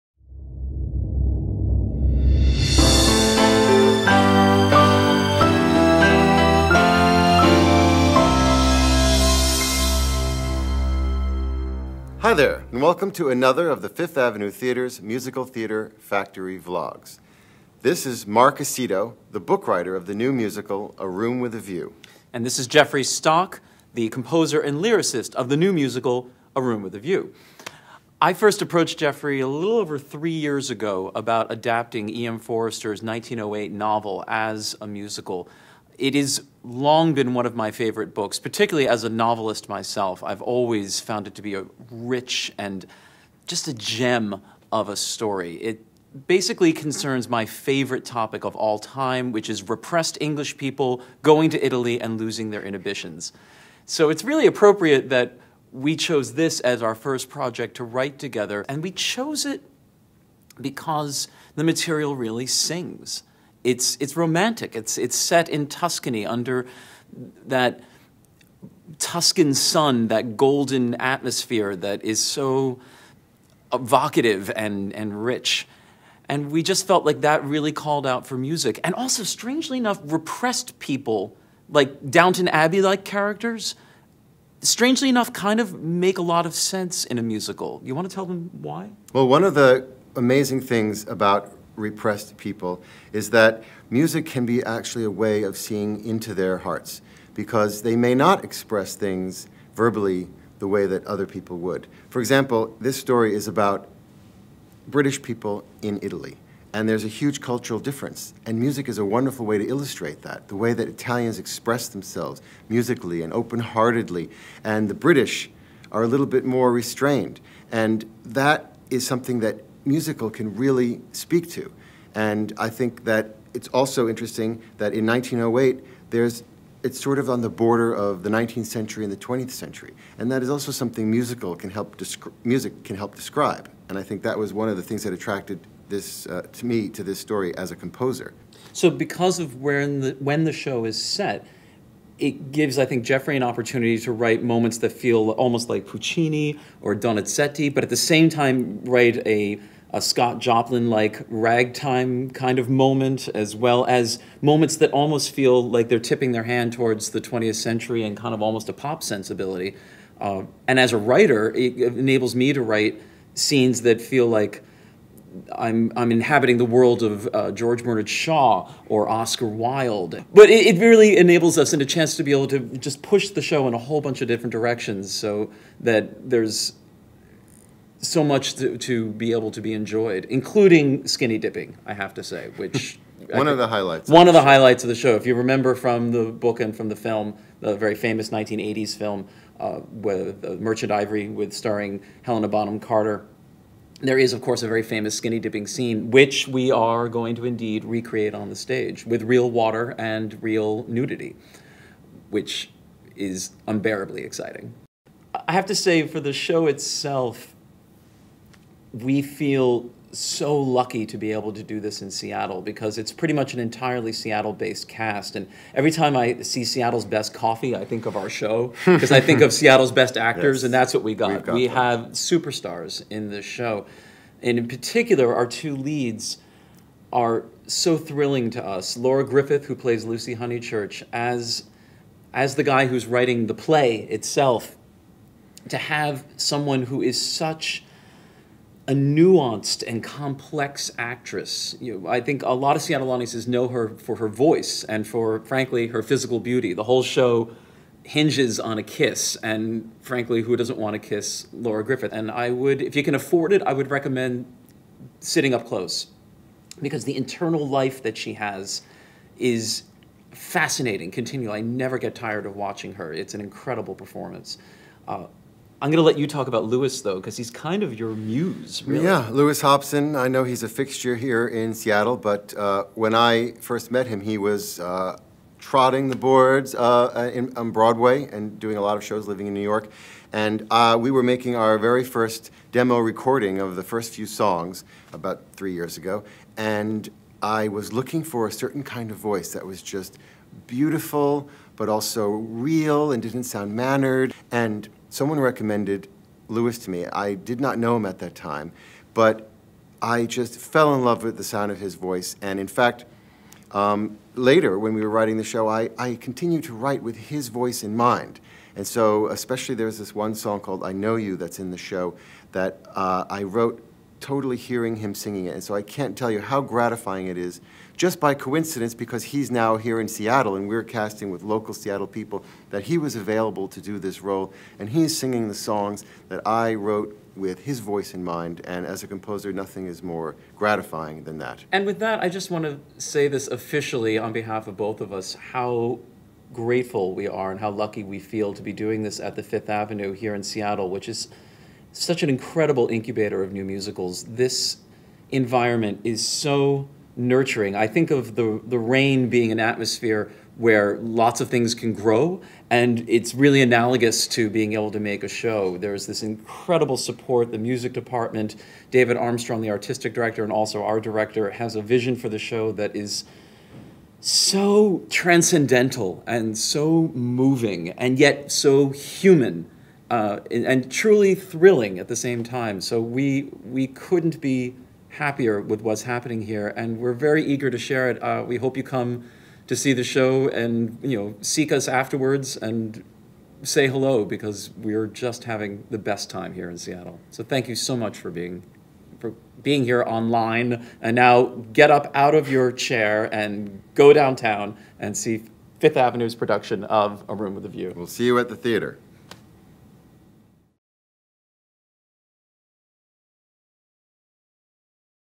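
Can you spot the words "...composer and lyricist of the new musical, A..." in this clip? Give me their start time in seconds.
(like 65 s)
24 s.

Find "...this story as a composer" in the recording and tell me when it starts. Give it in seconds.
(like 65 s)
137 s.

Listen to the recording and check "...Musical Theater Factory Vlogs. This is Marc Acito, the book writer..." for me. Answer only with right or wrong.
right.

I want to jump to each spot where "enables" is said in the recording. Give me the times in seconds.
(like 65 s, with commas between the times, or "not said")
161 s, 171 s.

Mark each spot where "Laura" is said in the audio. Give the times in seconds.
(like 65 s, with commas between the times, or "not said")
228 s, 251 s.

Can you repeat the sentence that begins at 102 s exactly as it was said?
For example, this story is about British people in Italy.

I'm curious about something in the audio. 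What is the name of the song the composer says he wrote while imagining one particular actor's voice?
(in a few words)
I Know You.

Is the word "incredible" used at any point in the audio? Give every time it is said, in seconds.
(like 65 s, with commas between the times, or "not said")
263 s, 342 s, 356 s.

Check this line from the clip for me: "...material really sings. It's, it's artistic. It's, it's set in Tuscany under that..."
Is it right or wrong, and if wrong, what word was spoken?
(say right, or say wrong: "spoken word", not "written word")
wrong: "romantic", not "artistic".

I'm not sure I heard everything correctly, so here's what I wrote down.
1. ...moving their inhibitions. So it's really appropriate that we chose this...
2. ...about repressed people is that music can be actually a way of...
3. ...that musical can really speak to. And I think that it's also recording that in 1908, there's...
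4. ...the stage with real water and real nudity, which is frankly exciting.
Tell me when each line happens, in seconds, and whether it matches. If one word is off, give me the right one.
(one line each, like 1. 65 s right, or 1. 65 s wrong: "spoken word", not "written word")
1. 52 s wrong: "losing", not "moving"
2. 91 s right
3. 119 s wrong: "interesting", not "recording"
4. 198 s wrong: "unbearably", not "frankly".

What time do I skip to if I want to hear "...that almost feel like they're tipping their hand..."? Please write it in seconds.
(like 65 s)
154 s.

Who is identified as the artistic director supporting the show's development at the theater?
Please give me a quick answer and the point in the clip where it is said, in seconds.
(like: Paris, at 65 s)
David Armstrong, at 358 s.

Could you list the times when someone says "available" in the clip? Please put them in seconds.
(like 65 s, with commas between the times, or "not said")
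323 s.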